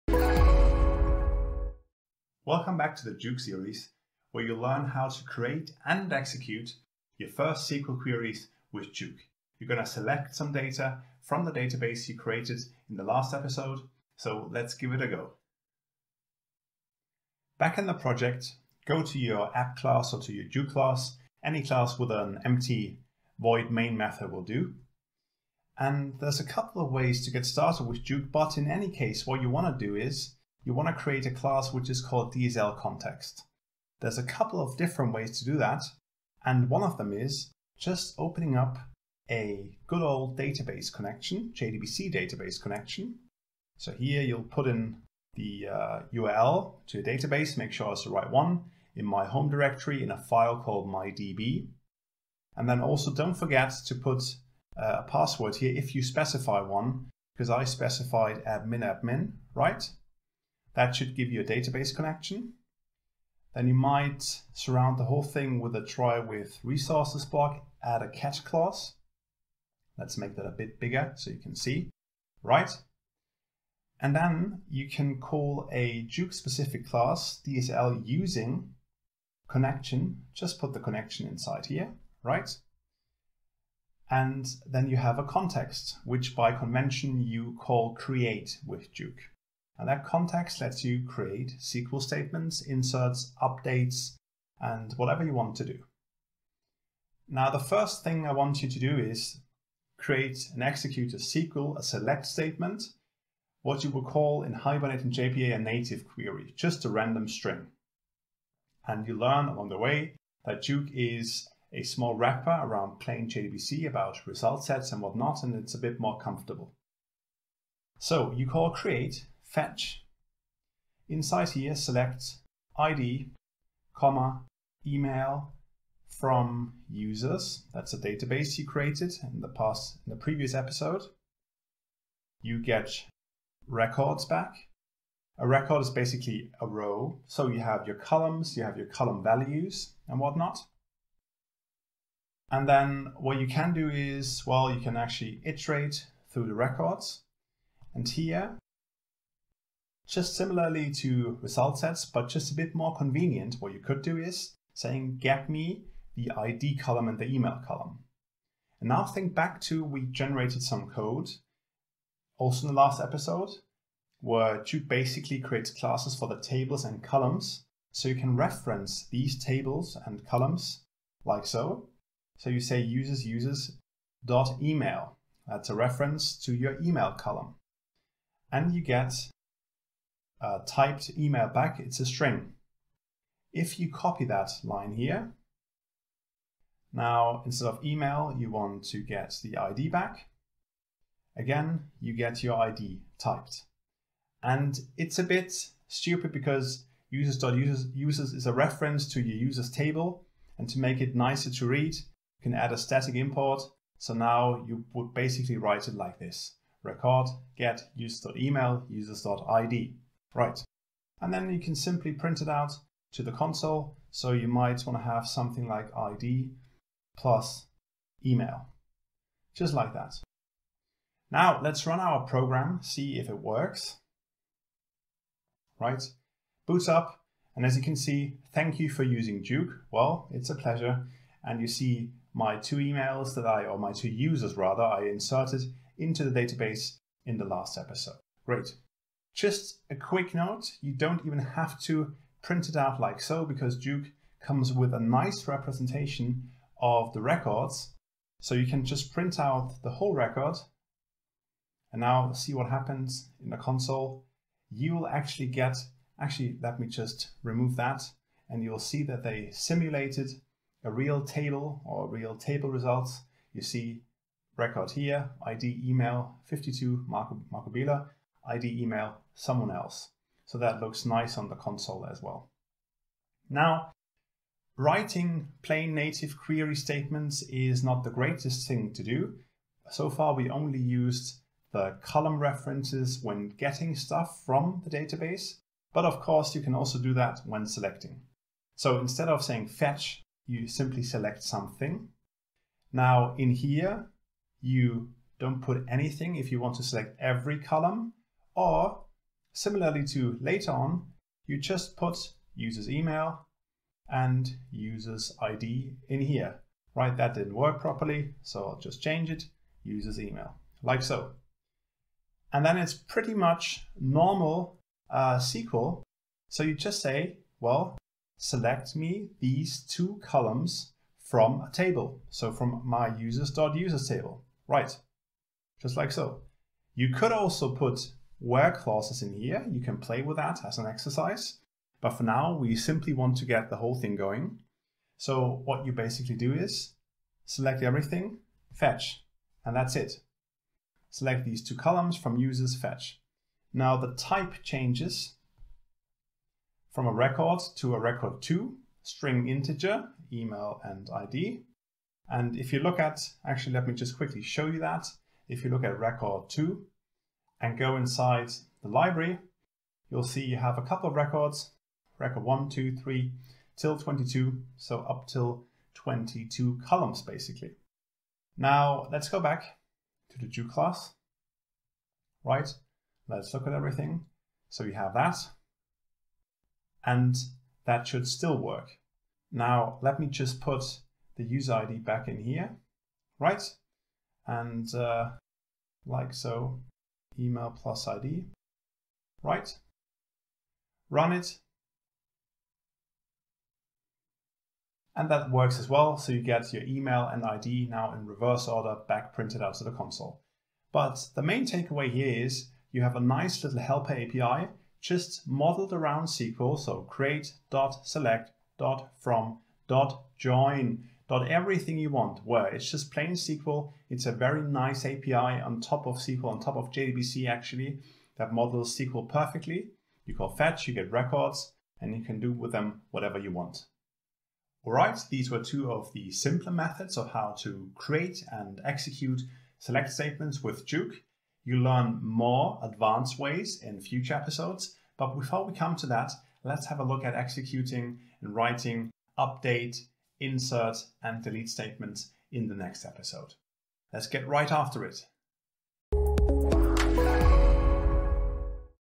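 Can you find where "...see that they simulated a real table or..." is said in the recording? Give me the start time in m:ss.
4:18.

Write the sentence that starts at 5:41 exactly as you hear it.
Select these two columns from users fetch.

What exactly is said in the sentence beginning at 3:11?
Again, you get your ID typed.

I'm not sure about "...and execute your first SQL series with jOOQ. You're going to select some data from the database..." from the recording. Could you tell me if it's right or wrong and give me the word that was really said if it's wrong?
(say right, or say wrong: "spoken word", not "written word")
wrong: "queries", not "series".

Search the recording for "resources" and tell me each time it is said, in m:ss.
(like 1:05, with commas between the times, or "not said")
1:06.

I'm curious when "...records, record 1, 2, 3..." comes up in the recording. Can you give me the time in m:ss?
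6:01.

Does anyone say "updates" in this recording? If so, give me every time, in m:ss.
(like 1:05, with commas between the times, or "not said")
1:33, 7:19.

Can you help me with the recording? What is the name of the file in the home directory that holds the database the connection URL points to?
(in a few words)
mydb.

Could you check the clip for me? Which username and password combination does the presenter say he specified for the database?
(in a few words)
admin admin.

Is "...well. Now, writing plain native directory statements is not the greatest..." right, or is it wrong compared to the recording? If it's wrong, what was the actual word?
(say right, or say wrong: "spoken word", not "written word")
wrong: "query", not "directory".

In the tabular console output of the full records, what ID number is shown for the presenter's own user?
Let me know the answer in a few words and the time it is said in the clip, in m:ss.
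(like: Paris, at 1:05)
52, at 4:26.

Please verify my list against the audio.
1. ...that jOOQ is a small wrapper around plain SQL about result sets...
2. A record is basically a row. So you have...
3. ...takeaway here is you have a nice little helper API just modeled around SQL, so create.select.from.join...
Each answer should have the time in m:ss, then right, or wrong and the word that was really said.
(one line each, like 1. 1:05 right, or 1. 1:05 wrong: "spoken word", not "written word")
1. 1:50 wrong: "JDBC", not "SQL"
2. 2:15 right
3. 6:41 right.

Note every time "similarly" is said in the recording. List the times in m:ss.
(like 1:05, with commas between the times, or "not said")
2:30, 4:59.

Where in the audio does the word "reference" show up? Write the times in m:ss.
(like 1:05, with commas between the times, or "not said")
2:48, 2:55, 3:18, 4:42.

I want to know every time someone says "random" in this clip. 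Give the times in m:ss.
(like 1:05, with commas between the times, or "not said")
1:46.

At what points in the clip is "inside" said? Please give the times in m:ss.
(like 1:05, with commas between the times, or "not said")
1:21, 2:01, 5:57.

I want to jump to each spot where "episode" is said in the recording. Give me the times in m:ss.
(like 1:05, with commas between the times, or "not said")
0:13, 2:10, 2:43, 3:57, 7:14, 7:23.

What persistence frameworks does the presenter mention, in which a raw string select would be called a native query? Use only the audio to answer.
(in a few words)
Hibernate and JPA.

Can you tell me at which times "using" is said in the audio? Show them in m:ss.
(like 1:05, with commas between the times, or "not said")
1:18, 3:49.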